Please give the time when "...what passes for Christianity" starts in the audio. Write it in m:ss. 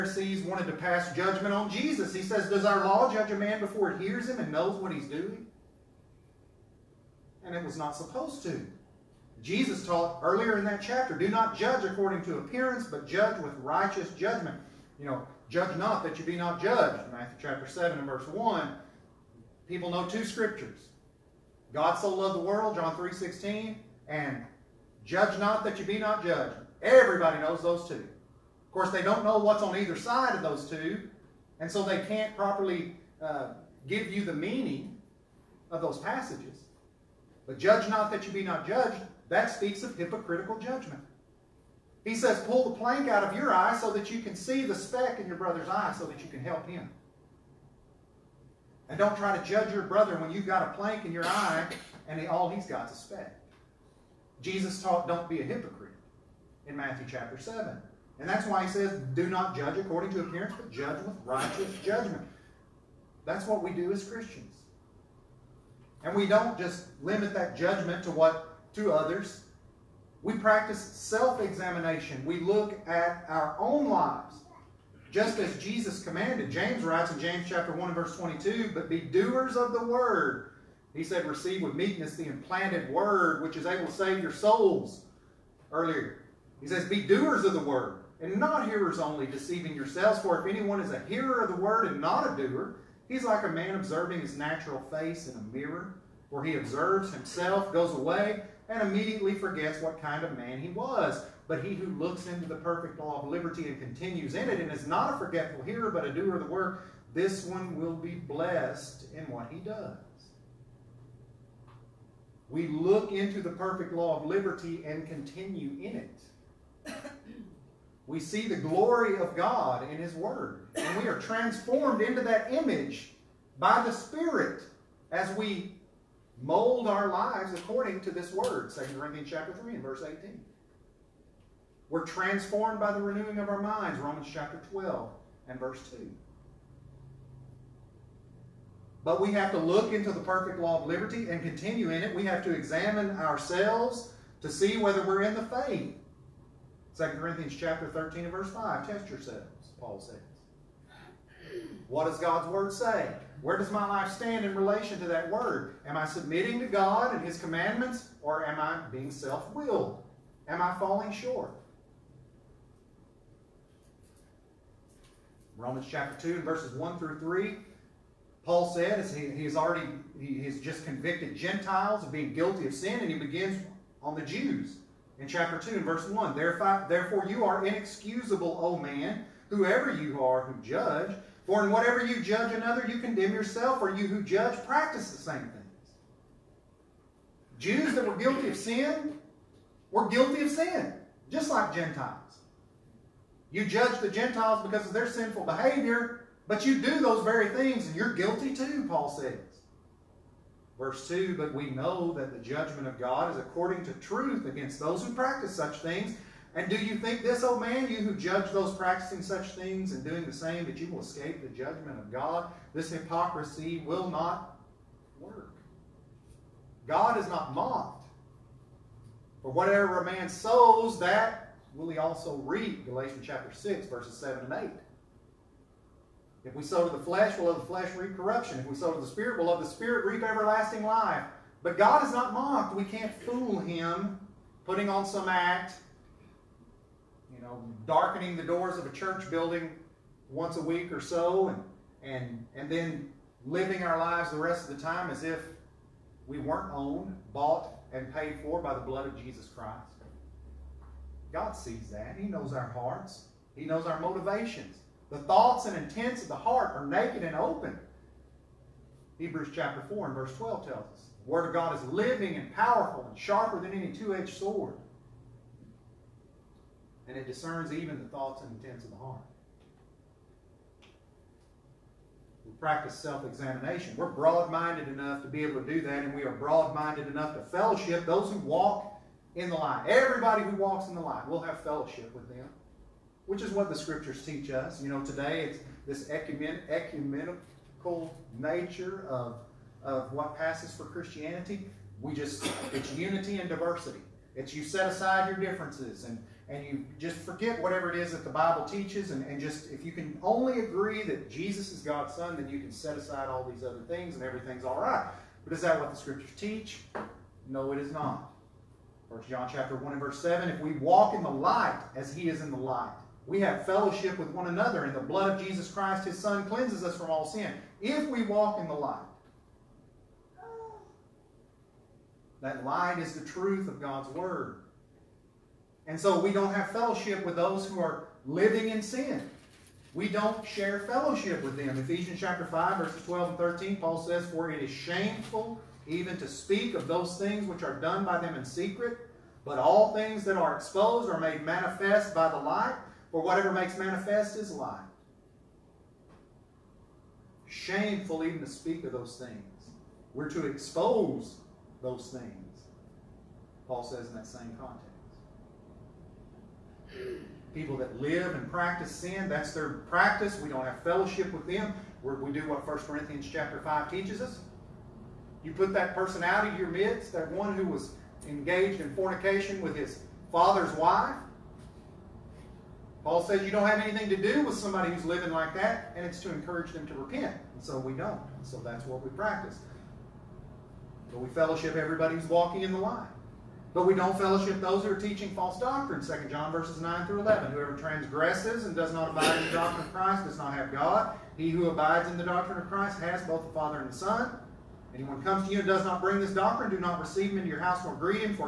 4:50.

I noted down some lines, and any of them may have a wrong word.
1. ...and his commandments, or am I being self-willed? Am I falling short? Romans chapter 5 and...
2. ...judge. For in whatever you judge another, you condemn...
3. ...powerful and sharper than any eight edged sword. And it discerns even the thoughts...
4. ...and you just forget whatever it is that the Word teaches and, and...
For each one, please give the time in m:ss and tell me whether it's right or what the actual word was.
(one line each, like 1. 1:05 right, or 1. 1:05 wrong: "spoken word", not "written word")
1. 2:37 wrong: "2", not "5"
2. 3:00 right
3. 4:22 wrong: "two", not "eight"
4. 4:56 wrong: "Bible", not "Word".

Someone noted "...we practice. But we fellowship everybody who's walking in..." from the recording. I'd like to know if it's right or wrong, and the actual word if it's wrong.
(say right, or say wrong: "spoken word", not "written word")
right.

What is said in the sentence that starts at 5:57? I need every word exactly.
People that live and practice sin, that's their practice.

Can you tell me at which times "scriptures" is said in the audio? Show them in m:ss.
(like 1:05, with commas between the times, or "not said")
0:20, 4:43, 5:05.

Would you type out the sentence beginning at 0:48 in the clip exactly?
And don't try to judge your brother when you've got a plank in your eye and all he's got is a speck.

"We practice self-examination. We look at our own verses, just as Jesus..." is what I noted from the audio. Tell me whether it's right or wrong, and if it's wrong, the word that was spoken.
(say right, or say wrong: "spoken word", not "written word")
wrong: "lives", not "verses".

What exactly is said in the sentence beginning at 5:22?
That light is the truth of God's Word.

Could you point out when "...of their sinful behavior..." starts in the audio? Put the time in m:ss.
3:14.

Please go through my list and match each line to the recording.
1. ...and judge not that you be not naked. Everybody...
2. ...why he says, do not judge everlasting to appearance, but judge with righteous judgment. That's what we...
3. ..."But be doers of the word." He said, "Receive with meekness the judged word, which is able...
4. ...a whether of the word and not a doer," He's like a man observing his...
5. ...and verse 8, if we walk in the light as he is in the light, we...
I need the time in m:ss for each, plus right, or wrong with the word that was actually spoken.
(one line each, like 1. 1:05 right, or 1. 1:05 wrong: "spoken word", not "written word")
1. 0:24 wrong: "judged", not "naked"
2. 0:58 wrong: "according", not "everlasting"
3. 1:18 wrong: "implanted", not "judged"
4. 1:30 wrong: "hearer", not "whether"
5. 5:09 wrong: "7", not "8".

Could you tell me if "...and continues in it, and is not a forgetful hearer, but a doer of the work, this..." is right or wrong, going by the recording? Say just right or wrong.
right.